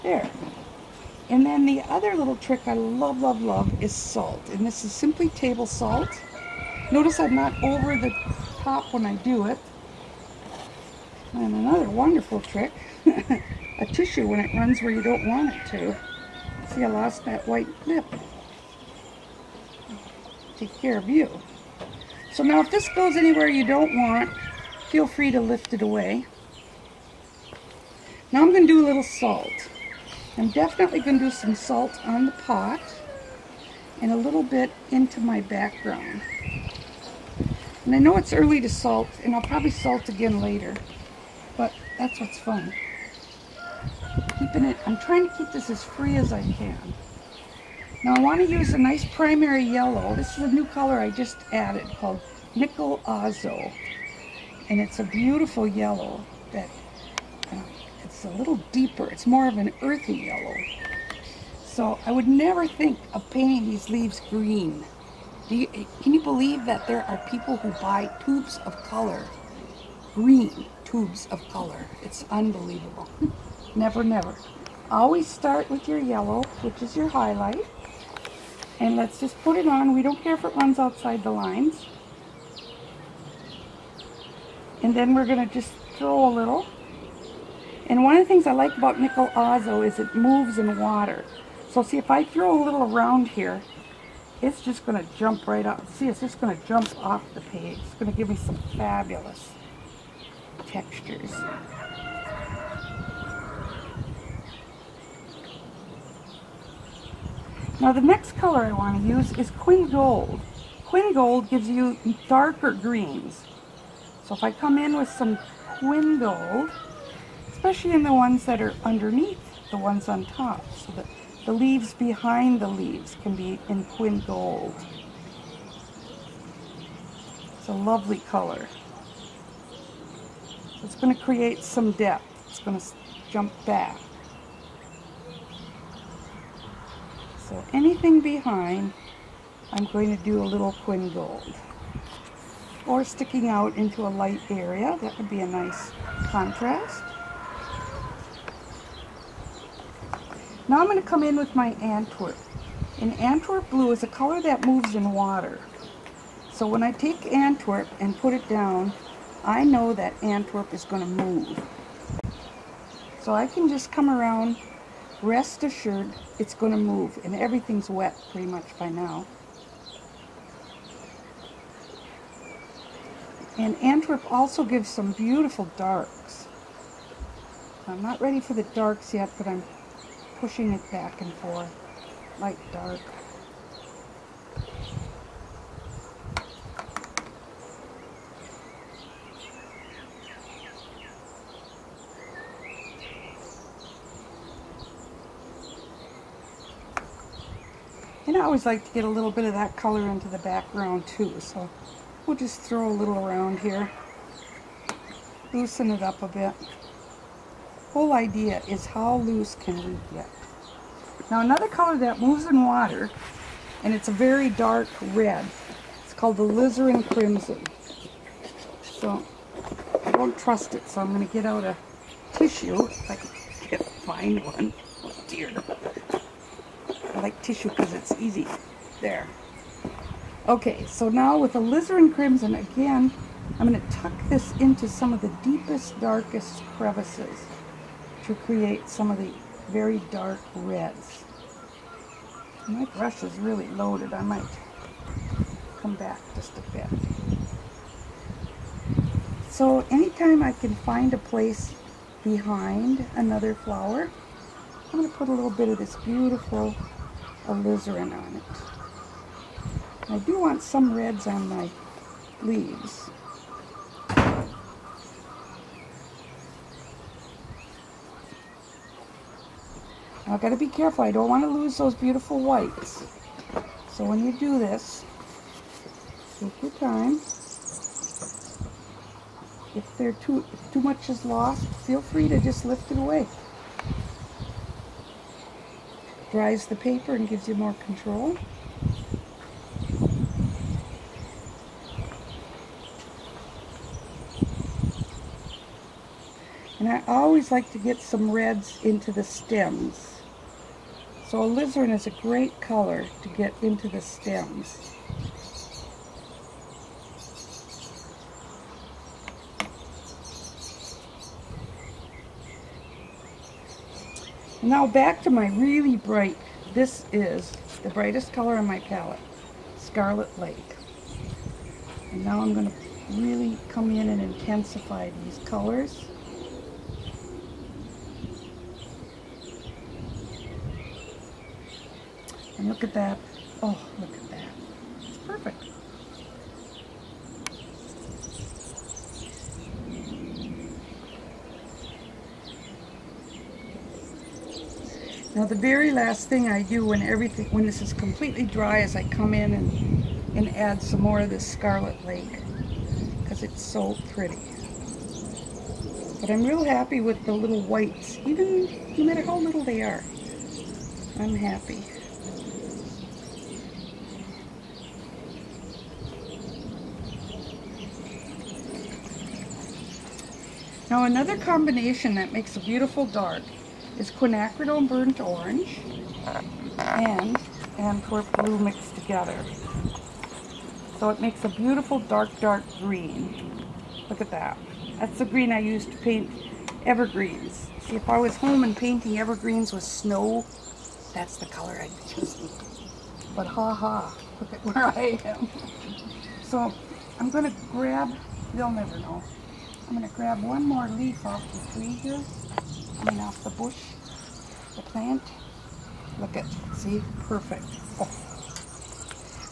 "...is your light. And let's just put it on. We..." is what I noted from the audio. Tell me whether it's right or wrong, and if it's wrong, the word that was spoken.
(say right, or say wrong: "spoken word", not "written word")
wrong: "highlight", not "light".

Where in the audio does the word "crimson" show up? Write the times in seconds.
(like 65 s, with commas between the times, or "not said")
217 s, 232 s.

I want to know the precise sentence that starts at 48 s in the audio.
Now I want to use a nice primary yellow.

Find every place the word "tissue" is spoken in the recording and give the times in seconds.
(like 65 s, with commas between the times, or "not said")
13 s, 222 s, 227 s.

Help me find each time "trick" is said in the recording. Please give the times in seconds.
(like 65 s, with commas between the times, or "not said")
2 s, 12 s.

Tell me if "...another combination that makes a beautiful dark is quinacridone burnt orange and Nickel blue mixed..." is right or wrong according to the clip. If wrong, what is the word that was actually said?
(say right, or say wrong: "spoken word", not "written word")
wrong: "Antwerp", not "Nickel".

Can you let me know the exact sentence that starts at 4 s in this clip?
And this is simply table salt.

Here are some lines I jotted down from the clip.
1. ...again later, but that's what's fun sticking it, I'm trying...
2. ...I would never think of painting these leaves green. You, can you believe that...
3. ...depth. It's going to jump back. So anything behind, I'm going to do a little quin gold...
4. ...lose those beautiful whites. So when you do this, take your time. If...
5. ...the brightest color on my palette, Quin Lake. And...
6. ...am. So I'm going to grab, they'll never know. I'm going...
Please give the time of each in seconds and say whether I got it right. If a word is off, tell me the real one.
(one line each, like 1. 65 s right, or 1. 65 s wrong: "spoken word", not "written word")
1. 40 s wrong: "keeping", not "sticking"
2. 62 s right
3. 131 s right
4. 271 s right
5. 317 s wrong: "Scarlet", not "Quin"
6. 395 s right.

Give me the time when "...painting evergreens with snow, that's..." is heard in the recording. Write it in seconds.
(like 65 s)
388 s.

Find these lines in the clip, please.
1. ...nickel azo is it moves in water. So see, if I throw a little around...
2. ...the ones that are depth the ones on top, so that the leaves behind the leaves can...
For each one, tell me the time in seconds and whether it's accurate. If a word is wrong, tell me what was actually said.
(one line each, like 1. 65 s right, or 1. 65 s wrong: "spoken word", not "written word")
1. 88 s right
2. 118 s wrong: "underneath", not "depth".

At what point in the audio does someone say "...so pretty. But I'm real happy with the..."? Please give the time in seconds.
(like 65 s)
353 s.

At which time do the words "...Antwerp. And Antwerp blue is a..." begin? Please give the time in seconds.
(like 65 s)
151 s.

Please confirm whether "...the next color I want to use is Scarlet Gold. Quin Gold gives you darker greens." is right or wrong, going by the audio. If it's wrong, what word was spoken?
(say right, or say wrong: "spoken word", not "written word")
wrong: "Quin", not "Scarlet".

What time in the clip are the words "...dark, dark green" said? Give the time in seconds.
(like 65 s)
381 s.